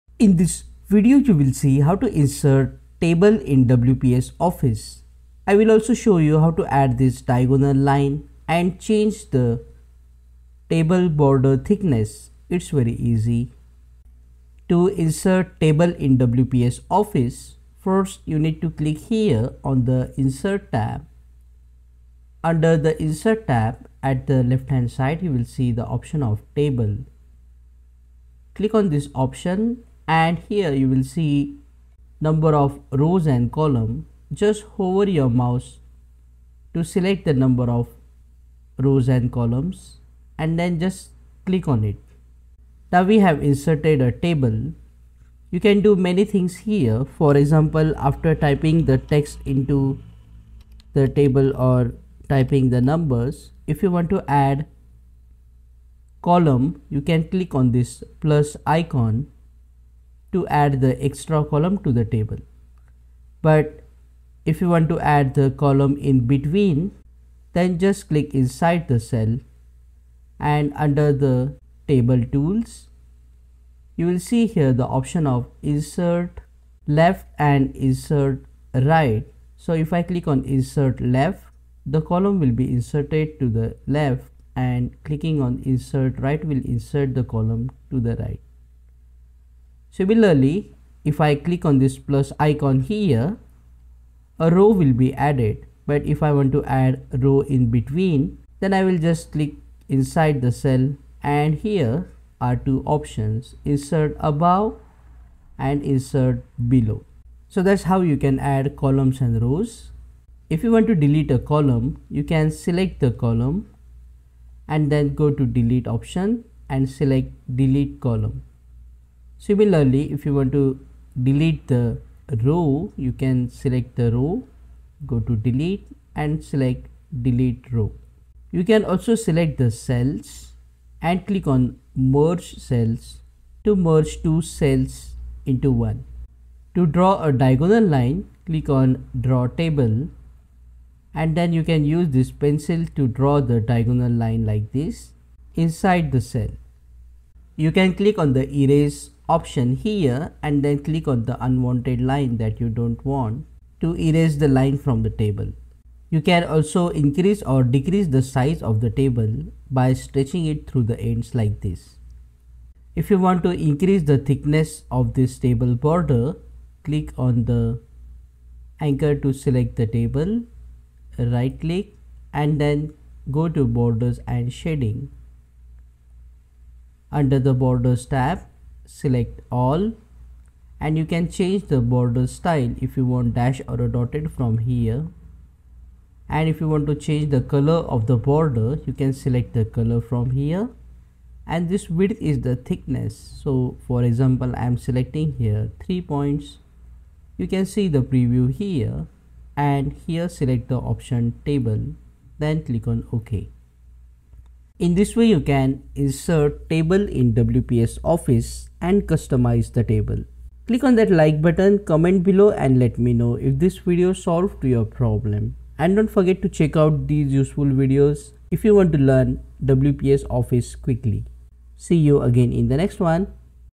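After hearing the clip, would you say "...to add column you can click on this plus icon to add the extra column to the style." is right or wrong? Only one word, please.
wrong.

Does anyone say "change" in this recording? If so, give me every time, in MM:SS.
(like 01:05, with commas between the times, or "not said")
00:08, 03:01, 03:06.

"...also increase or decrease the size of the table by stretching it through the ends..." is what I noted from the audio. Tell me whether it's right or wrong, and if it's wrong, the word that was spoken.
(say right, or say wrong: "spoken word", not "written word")
right.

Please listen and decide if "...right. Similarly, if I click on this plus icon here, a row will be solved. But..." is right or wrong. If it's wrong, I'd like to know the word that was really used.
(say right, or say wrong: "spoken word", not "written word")
wrong: "added", not "solved".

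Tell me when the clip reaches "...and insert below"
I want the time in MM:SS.
01:45.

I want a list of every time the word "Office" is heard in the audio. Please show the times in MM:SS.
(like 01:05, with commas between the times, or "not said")
00:04, 00:17, 03:28, 03:40.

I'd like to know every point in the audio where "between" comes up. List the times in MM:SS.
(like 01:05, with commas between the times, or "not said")
01:06, 01:37.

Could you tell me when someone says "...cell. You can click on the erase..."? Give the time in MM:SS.
02:26.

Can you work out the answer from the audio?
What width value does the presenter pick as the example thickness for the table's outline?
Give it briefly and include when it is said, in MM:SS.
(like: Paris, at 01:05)
3 points, at 03:15.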